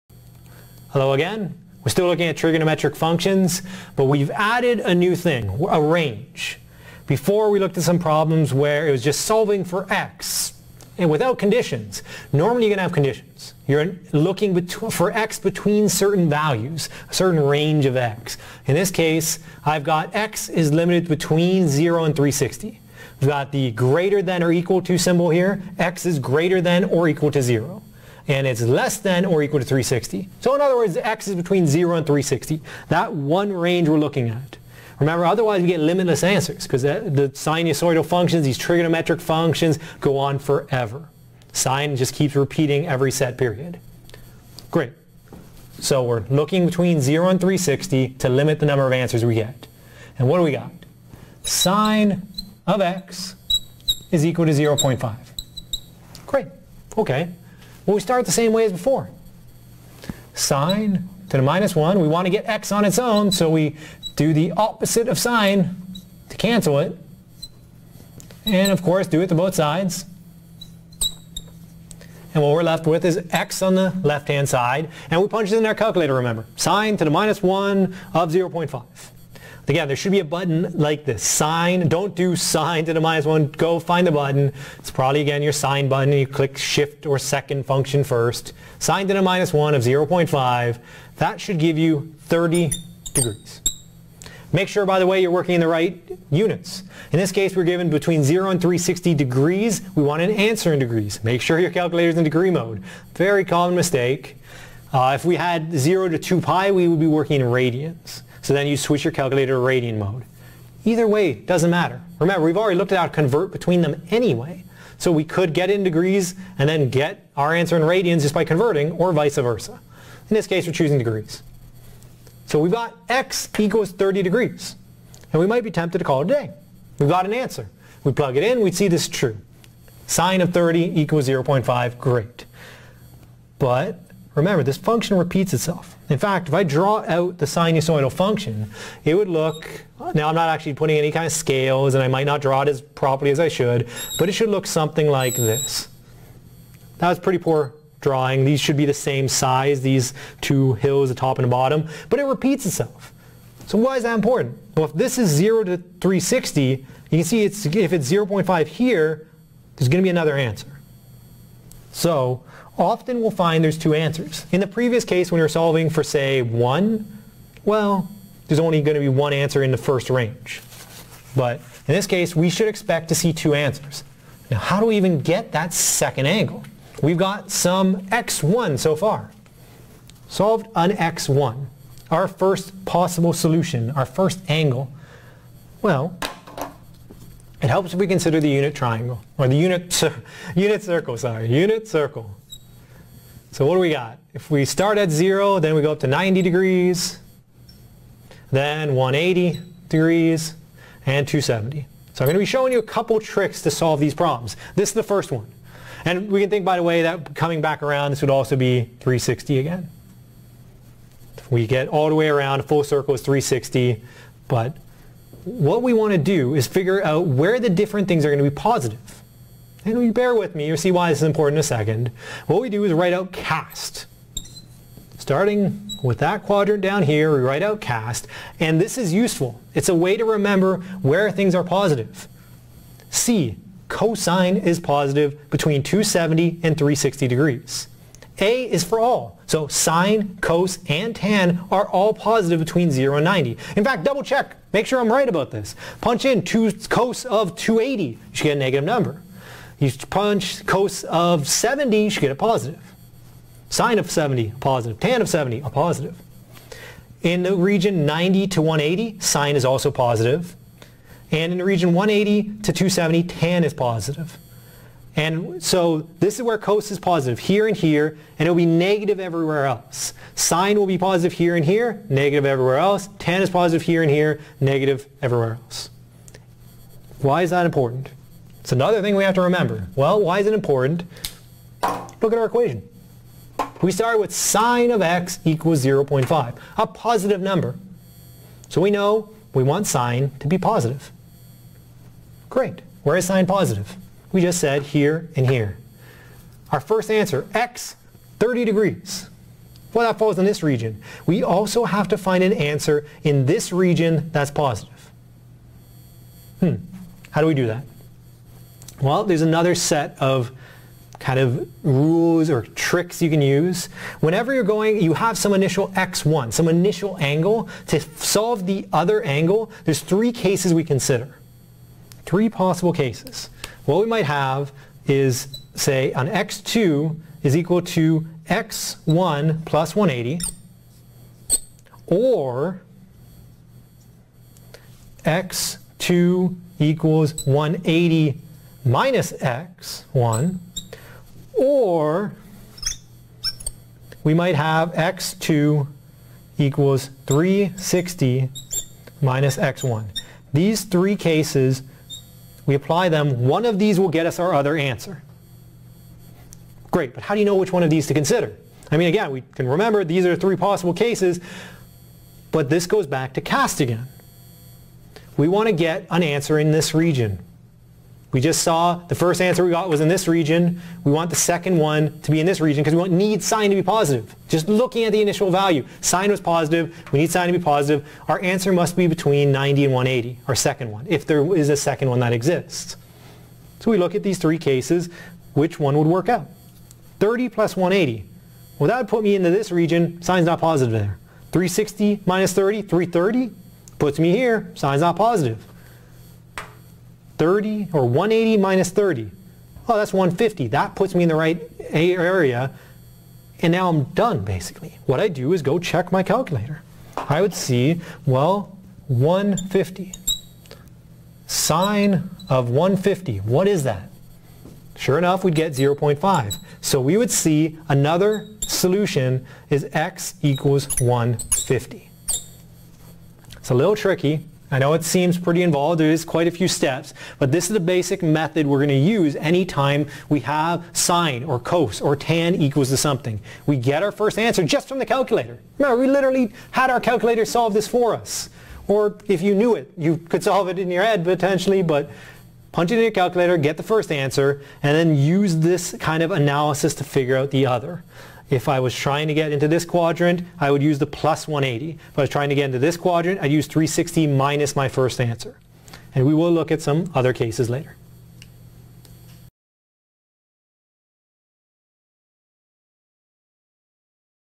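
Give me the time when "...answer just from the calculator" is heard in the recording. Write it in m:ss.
7:14.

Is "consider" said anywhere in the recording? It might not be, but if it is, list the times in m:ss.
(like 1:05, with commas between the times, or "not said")
3:08, 5:20, 5:58.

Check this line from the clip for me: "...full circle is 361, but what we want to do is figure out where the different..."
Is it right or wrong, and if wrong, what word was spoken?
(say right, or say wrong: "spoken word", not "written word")
wrong: "360", not "361".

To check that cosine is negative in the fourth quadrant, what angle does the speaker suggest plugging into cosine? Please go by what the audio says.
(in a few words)
280.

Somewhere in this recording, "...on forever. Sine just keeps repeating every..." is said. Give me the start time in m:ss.
0:40.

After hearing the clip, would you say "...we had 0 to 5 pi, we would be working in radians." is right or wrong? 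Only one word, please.
wrong.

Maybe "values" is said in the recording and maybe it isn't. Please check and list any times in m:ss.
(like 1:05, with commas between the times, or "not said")
0:16, 6:15.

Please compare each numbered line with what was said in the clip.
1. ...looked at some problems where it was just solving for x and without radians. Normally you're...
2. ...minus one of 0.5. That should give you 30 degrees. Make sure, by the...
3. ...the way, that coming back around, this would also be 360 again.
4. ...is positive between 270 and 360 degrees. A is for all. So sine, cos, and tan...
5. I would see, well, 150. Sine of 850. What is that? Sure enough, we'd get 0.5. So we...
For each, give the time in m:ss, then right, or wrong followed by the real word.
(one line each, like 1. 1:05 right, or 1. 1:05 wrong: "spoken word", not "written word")
1. 0:07 wrong: "conditions", not "radians"
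2. 1:29 right
3. 3:26 right
4. 3:54 right
5. 6:47 wrong: "150", not "850".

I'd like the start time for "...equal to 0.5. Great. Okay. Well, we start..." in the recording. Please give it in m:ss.
0:54.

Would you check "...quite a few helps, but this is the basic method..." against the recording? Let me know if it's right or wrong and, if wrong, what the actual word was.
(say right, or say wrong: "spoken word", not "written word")
wrong: "steps", not "helps".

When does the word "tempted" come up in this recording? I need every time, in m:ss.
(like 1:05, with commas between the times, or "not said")
2:05.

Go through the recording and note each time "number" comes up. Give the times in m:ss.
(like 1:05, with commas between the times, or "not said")
0:48, 4:08, 4:47.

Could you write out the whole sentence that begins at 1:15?
And we punch it in our calculator, remember.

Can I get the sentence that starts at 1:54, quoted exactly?
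So we could get in degrees and then get our answer in radians just by converting, or vice versa.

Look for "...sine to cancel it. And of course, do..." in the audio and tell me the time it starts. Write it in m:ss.
1:05.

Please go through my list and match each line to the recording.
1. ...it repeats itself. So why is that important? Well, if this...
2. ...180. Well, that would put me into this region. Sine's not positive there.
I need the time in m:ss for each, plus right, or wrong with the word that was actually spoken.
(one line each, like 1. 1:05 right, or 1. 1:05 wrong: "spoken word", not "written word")
1. 2:32 right
2. 6:27 right.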